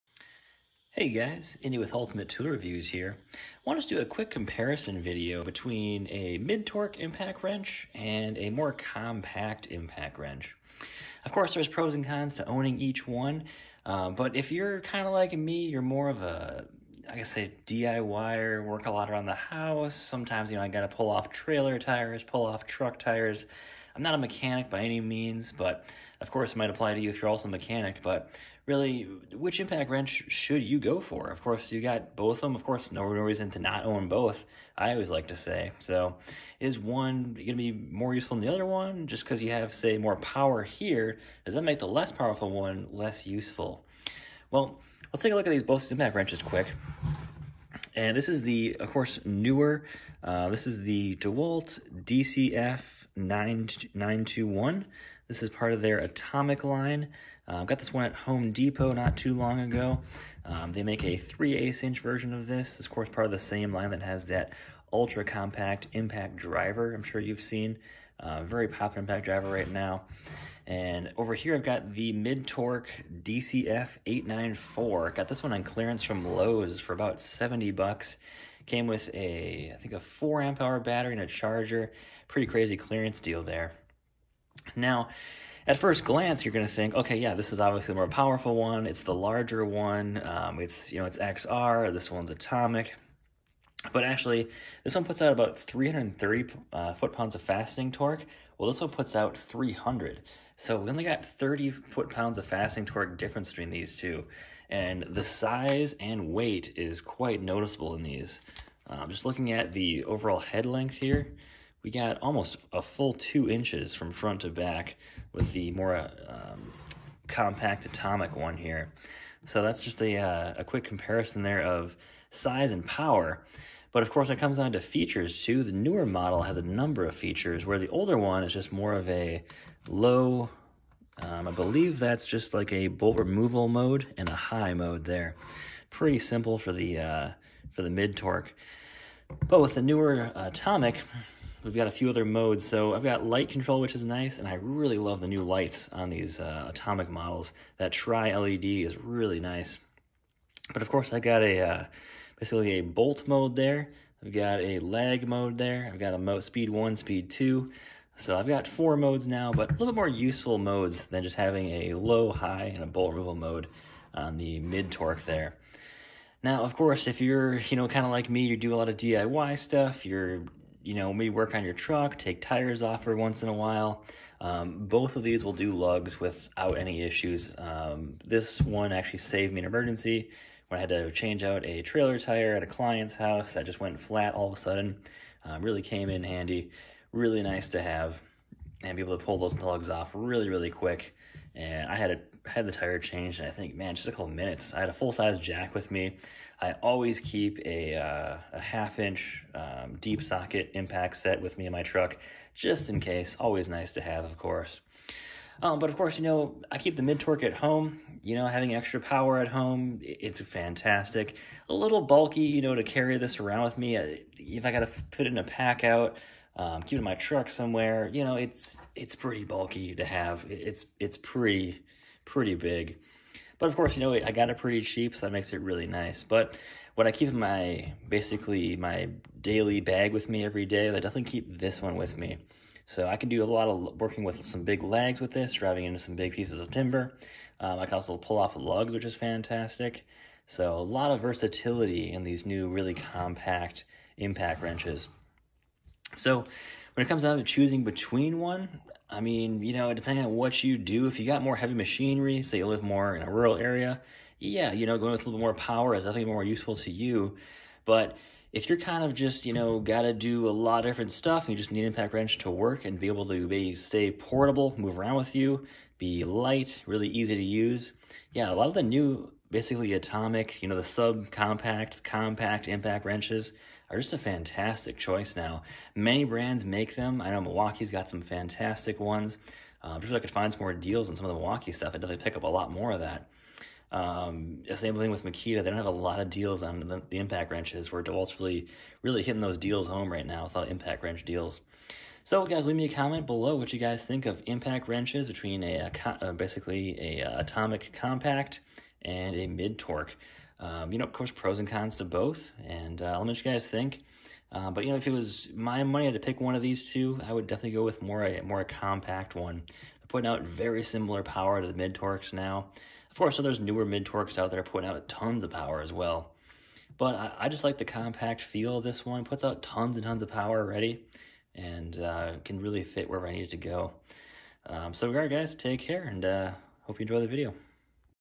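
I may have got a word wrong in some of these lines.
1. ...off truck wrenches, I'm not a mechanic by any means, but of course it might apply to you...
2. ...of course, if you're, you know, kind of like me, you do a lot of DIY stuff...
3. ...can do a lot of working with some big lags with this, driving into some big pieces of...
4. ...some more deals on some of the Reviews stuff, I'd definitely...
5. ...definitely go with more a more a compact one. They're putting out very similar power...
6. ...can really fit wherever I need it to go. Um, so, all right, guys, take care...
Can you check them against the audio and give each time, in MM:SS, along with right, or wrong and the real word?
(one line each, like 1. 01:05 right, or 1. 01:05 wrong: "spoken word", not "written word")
1. 00:22 wrong: "tires", not "wrenches"
2. 02:46 right
3. 03:53 right
4. 04:40 wrong: "Milwaukee", not "Reviews"
5. 05:07 right
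6. 05:22 right.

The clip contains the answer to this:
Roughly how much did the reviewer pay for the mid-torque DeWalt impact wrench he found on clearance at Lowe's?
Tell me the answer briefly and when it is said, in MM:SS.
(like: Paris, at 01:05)
$70, at 01:17.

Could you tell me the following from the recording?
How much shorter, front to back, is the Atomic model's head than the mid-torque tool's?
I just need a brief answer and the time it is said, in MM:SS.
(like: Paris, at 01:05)
2 inches, at 01:53.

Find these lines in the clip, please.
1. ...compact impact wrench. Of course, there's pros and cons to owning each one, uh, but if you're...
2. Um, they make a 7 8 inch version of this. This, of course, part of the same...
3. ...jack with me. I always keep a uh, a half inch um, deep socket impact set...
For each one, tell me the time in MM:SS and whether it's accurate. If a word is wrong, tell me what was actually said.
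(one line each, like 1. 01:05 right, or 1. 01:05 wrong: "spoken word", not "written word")
1. 00:08 right
2. 01:00 wrong: "3", not "7"
3. 03:15 right.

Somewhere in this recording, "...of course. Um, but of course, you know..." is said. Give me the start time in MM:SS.
03:24.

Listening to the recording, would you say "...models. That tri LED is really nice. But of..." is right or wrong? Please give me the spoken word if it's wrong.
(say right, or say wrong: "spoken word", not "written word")
right.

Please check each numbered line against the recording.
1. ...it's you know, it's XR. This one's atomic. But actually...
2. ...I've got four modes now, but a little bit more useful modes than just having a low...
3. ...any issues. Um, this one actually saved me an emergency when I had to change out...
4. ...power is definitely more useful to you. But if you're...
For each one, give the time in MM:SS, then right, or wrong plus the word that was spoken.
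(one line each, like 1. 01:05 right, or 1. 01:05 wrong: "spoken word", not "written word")
1. 01:30 right
2. 02:38 right
3. 02:56 right
4. 04:15 right.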